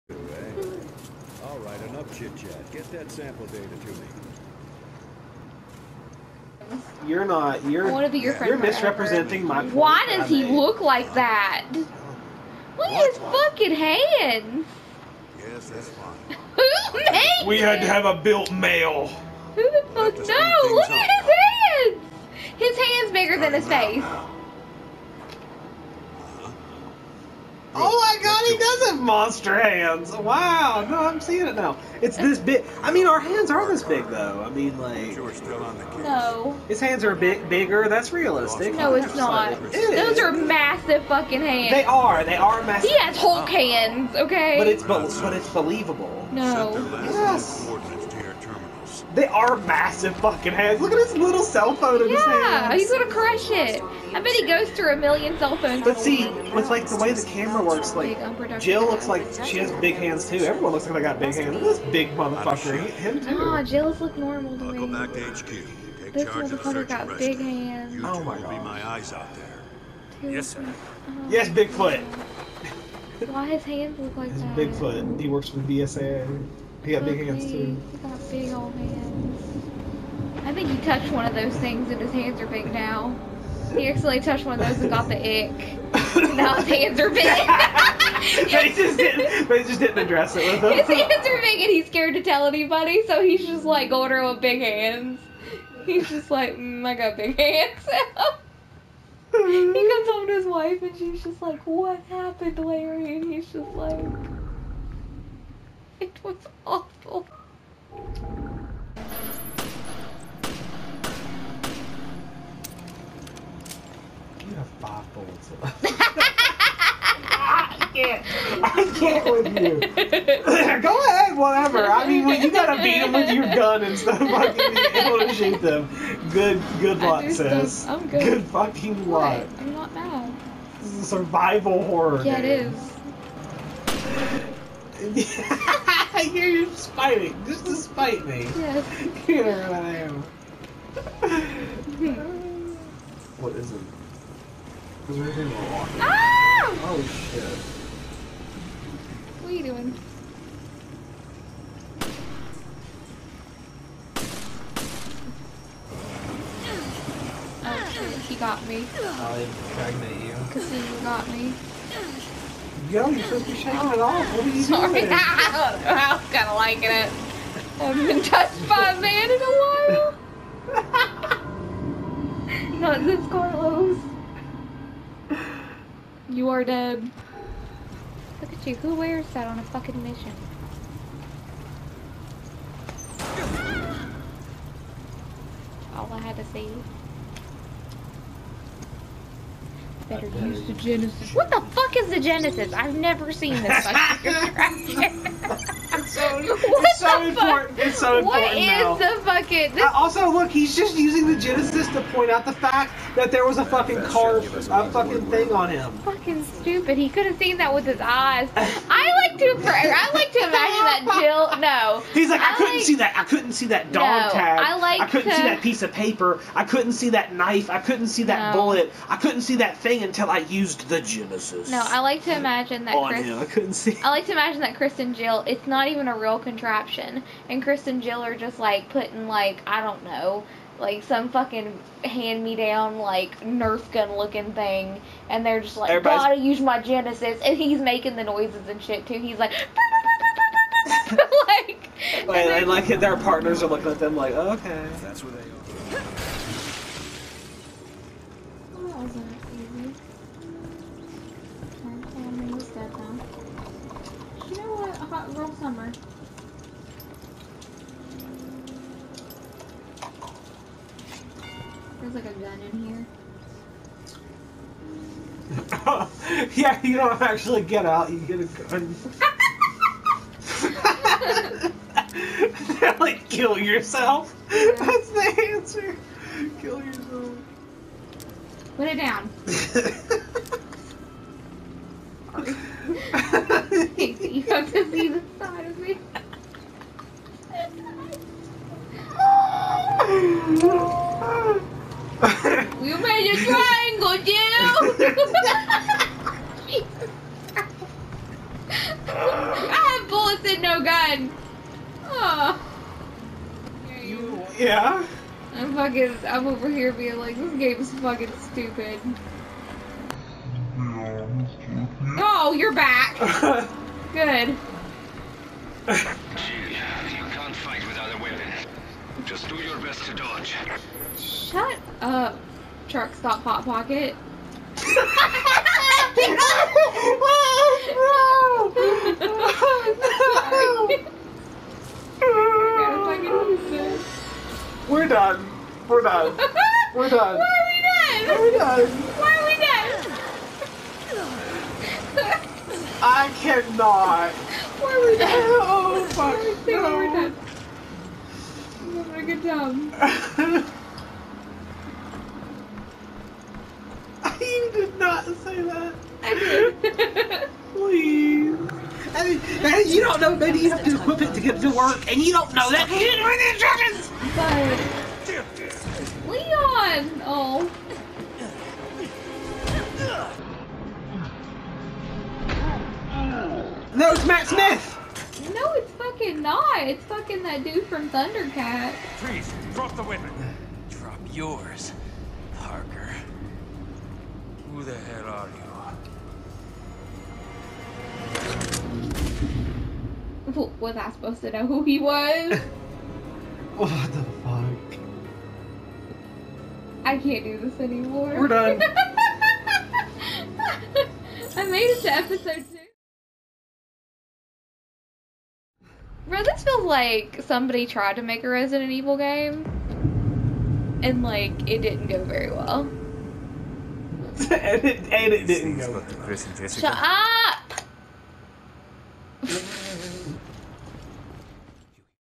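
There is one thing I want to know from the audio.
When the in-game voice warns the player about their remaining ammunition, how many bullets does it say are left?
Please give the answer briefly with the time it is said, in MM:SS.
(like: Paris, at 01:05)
5, at 01:54.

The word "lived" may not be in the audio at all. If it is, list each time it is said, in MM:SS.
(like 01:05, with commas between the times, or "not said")
not said.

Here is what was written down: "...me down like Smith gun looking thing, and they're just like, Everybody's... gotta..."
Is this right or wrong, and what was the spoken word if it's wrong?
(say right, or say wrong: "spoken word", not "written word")
wrong: "Nerf", not "Smith".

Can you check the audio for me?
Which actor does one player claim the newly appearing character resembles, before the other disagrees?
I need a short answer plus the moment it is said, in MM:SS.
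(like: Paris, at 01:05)
Matt Smith, at 06:14.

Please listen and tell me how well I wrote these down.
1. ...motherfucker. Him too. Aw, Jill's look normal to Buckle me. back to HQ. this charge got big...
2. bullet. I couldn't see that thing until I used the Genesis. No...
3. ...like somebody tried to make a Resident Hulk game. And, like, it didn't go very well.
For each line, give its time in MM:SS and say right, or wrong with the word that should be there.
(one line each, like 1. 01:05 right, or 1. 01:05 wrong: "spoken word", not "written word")
1. 01:02 right
2. 03:38 right
3. 06:46 wrong: "Evil", not "Hulk".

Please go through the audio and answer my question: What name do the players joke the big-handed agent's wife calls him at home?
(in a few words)
Larry.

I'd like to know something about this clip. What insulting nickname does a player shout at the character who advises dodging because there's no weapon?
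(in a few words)
truck stop hot pocket.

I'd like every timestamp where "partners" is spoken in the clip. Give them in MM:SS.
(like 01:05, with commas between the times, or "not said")
04:03.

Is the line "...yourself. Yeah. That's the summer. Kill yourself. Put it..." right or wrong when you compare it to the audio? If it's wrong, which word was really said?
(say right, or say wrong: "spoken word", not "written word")
wrong: "answer", not "summer".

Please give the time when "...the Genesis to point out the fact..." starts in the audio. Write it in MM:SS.
03:21.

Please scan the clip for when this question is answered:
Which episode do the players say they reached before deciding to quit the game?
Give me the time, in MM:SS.
06:42.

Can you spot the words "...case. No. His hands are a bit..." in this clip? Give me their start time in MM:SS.
00:35.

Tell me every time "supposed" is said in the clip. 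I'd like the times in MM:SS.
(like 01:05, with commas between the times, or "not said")
02:43, 06:31.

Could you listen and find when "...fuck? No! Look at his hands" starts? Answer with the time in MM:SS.
00:19.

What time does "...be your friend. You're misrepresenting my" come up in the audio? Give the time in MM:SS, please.
00:08.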